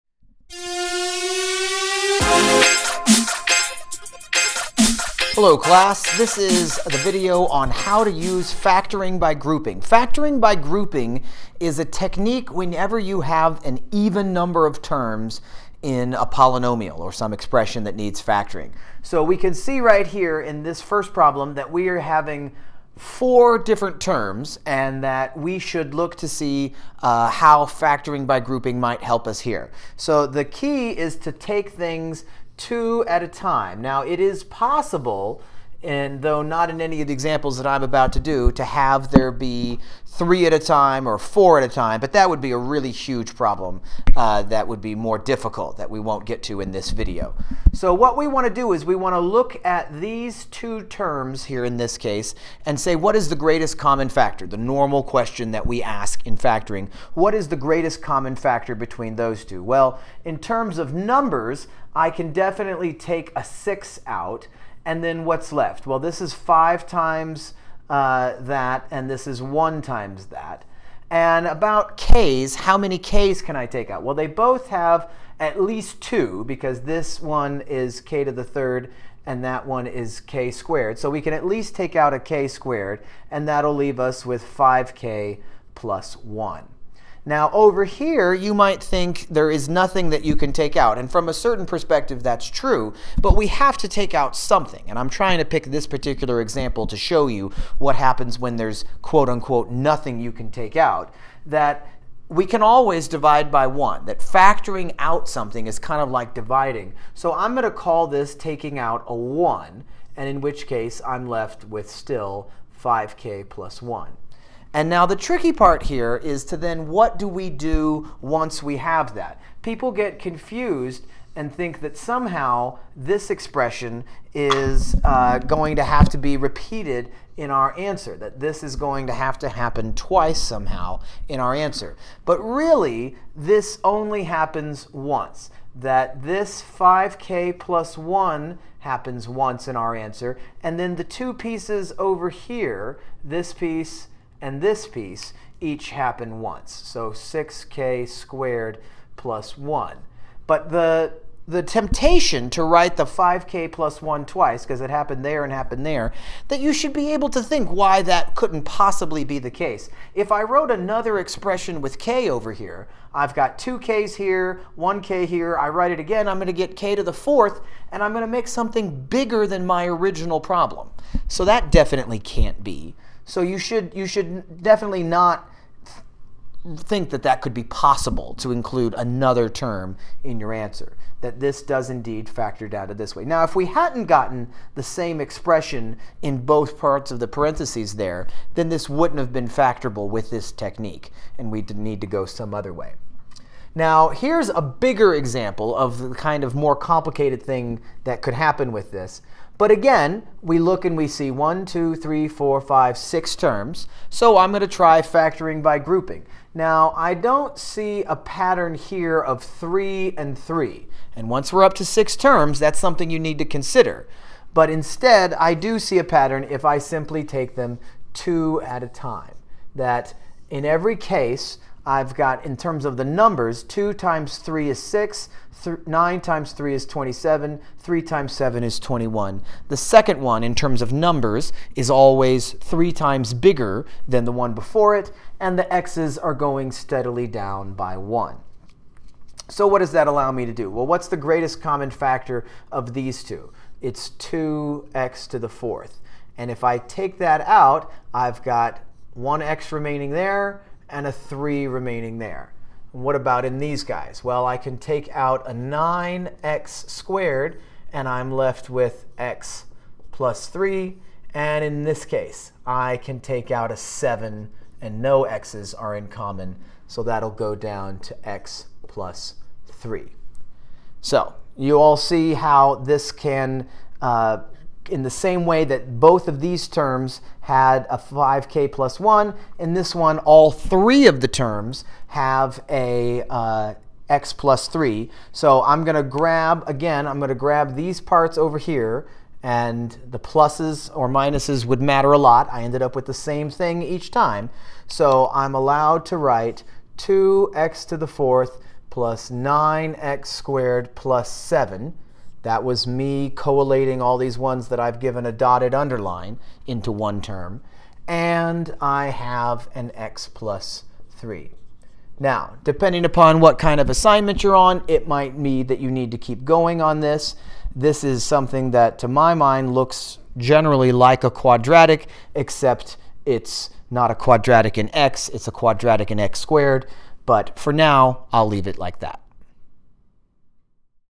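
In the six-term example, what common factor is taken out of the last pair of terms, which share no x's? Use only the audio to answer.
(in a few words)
7.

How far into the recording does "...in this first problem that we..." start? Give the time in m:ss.
0:20.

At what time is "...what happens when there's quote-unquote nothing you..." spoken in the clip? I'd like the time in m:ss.
1:37.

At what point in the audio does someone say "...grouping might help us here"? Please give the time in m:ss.
0:28.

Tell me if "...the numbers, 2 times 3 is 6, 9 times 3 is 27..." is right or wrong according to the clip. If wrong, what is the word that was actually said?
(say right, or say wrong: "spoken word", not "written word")
right.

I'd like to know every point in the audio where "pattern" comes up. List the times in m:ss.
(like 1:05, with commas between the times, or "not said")
3:28, 3:36.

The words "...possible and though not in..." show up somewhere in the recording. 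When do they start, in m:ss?
0:34.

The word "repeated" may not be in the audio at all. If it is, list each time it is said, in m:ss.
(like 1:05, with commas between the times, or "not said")
2:06.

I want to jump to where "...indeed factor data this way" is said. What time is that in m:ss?
3:01.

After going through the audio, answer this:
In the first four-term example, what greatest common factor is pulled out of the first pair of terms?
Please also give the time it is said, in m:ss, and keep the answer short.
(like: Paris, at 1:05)
6k^2, at 1:22.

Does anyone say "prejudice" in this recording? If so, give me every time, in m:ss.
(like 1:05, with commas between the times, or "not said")
not said.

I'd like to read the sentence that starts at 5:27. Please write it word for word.
But for now, I'll leave it like that.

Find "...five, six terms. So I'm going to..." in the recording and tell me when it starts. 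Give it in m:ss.
3:22.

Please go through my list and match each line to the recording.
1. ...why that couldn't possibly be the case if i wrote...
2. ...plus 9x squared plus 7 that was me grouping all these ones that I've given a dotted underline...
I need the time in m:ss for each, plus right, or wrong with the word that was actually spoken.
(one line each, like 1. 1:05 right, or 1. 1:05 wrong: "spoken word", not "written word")
1. 2:37 right
2. 4:58 wrong: "collating", not "grouping".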